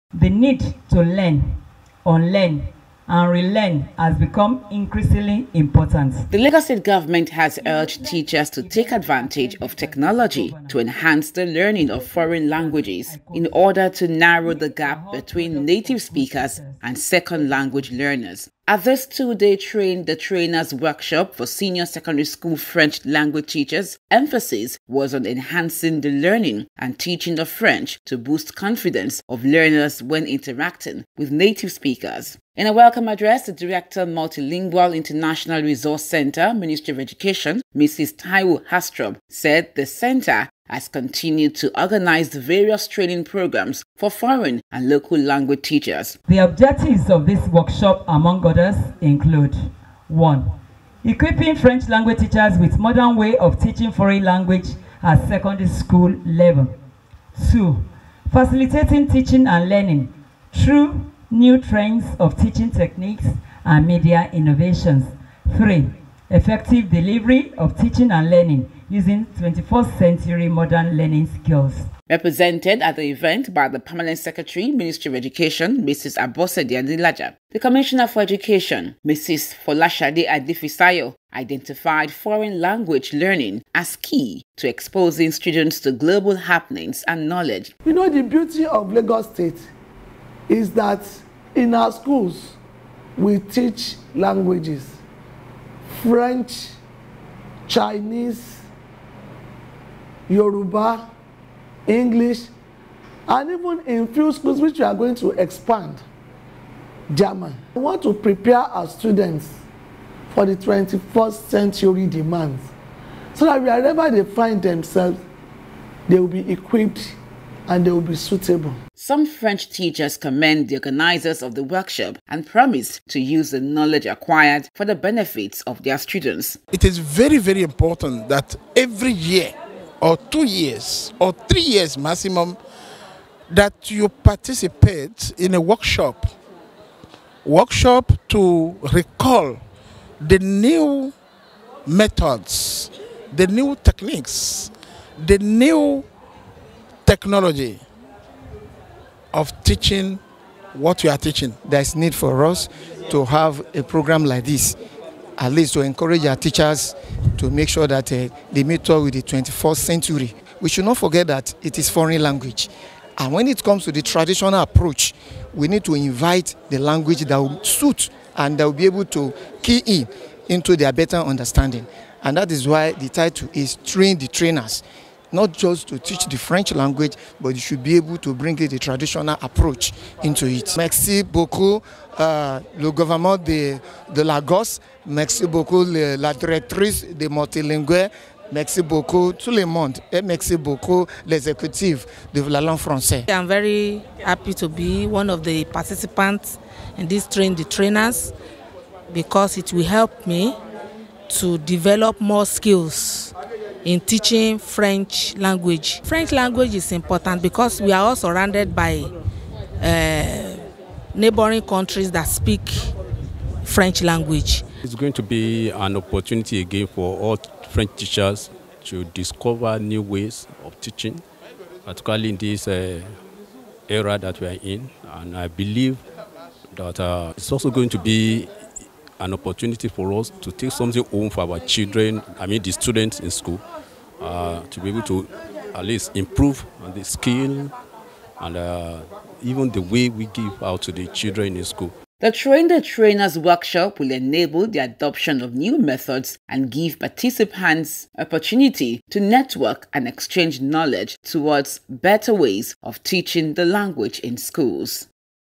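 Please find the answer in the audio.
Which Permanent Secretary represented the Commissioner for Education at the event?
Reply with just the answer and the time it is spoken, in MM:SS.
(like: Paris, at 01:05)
Abosede Adelaja, at 01:15.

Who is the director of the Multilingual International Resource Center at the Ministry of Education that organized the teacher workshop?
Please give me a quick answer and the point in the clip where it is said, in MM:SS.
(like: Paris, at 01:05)
Taiwo Hastrom, at 00:37.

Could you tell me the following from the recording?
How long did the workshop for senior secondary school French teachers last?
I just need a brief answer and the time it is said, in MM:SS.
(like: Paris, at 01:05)
2 days, at 00:19.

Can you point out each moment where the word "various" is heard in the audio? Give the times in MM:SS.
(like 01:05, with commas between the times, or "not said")
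00:42.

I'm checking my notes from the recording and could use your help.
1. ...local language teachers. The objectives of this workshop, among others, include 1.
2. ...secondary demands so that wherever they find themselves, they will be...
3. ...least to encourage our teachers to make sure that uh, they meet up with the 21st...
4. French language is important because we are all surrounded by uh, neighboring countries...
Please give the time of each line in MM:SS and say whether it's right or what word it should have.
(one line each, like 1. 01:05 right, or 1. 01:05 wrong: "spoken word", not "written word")
1. 00:44 right
2. 01:51 wrong: "century", not "secondary"
3. 02:35 right
4. 03:26 right.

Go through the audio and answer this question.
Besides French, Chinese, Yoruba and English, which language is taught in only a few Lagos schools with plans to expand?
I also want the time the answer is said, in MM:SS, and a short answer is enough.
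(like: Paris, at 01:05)
German, at 01:47.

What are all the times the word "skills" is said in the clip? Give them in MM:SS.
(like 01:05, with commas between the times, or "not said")
01:11, 03:22, 03:57.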